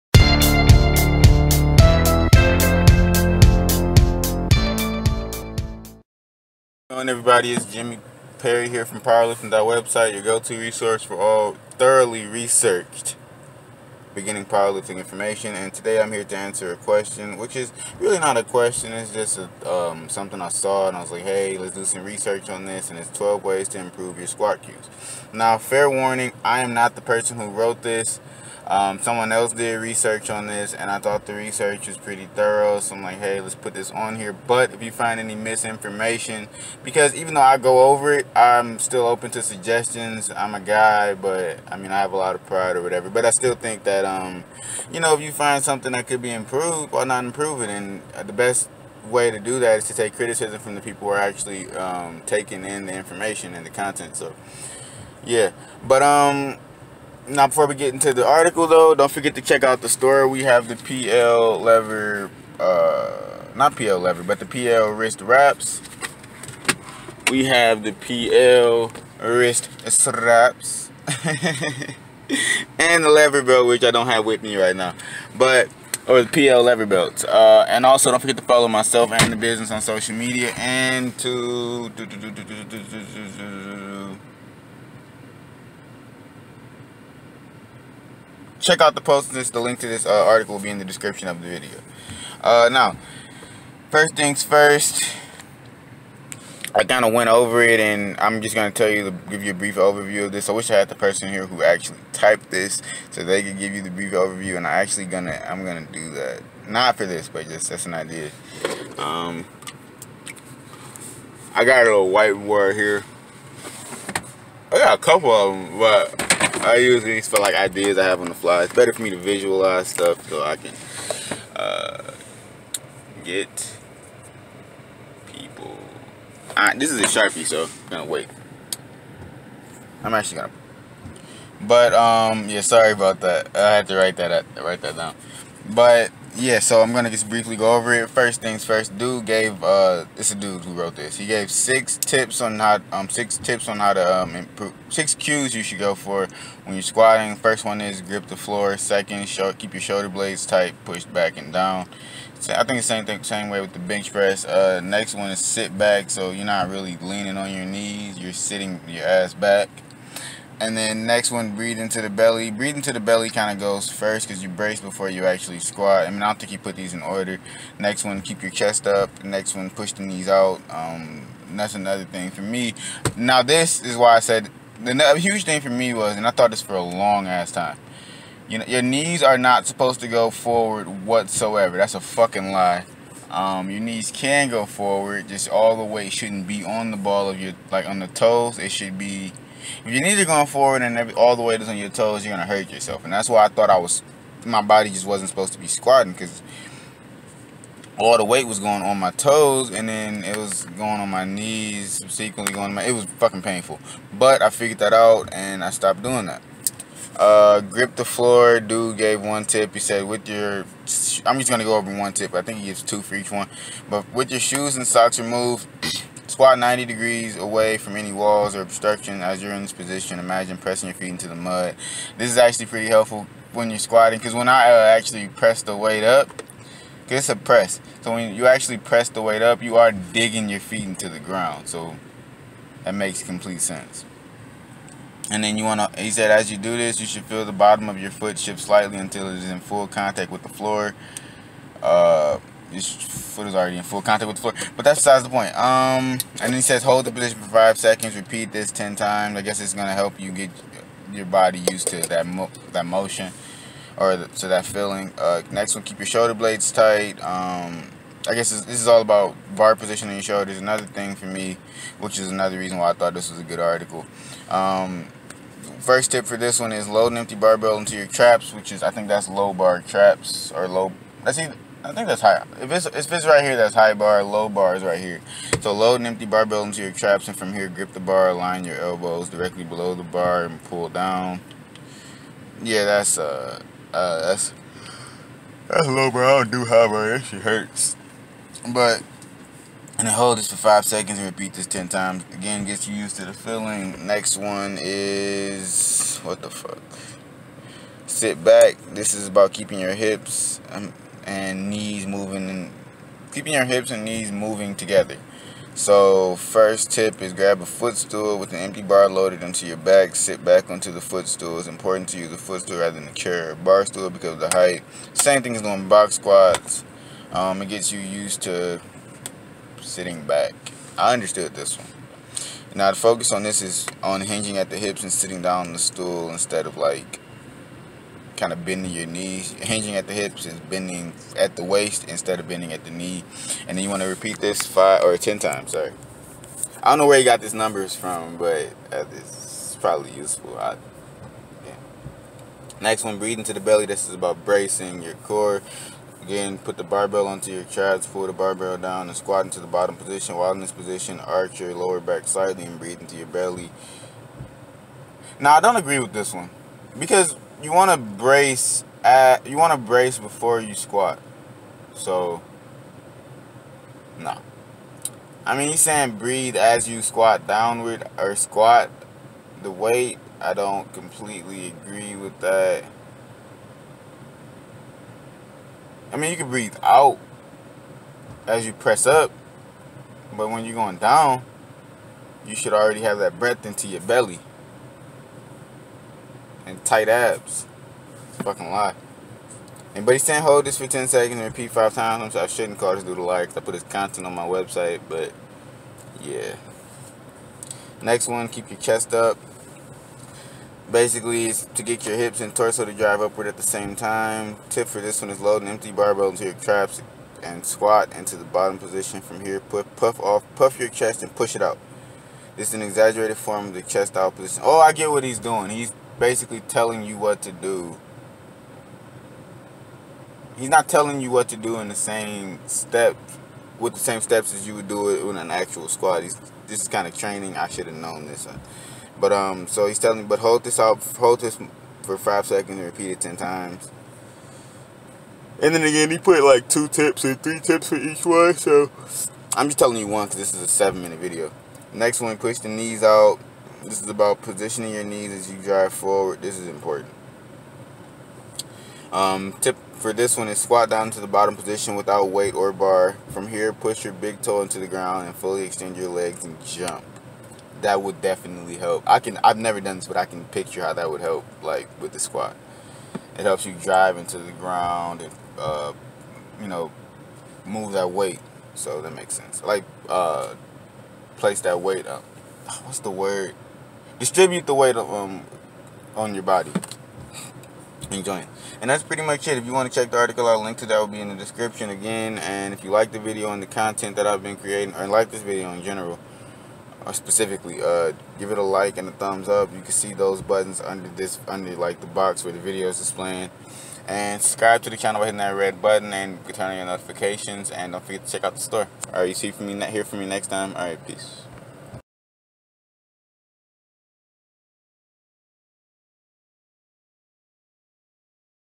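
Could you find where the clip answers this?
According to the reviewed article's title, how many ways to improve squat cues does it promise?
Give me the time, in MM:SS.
00:23.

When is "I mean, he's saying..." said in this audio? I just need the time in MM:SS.
06:05.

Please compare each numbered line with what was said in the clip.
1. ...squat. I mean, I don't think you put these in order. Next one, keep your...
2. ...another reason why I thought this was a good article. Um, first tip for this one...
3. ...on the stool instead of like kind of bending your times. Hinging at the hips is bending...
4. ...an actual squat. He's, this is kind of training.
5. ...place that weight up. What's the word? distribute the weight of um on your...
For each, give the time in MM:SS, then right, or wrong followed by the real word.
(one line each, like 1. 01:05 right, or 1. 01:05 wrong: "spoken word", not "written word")
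1. 02:45 right
2. 04:22 right
3. 05:25 wrong: "knees", not "times"
4. 07:05 right
5. 07:51 right.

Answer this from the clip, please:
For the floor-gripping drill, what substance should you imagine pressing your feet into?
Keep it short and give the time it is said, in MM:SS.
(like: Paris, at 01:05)
Mud, at 03:41.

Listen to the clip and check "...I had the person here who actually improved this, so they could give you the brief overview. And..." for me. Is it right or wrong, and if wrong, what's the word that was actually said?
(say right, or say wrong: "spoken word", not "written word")
wrong: "typed", not "improved".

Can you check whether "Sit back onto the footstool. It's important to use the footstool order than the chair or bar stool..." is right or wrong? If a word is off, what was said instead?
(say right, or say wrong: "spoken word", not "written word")
wrong: "rather", not "order".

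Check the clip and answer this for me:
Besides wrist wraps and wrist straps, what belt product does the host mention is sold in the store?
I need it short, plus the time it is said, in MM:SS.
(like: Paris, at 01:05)
PL lever belt, at 01:16.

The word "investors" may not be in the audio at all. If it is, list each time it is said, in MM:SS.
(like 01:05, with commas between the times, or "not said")
not said.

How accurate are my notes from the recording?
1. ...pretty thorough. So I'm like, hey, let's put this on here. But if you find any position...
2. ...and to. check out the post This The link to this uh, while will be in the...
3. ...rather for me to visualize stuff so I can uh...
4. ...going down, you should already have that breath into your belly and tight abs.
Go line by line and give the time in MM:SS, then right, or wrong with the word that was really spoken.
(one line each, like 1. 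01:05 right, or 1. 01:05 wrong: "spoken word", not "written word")
1. 00:31 wrong: "misinformation", not "position"
2. 01:20 wrong: "article", not "while"
3. 01:58 wrong: "better", not "rather"
4. 06:20 right.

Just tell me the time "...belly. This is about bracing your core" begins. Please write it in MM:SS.
05:43.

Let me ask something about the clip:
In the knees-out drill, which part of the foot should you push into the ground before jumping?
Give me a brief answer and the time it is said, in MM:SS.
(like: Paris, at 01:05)
Big toe, at 07:34.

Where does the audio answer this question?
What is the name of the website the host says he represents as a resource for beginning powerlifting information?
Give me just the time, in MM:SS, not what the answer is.
00:08.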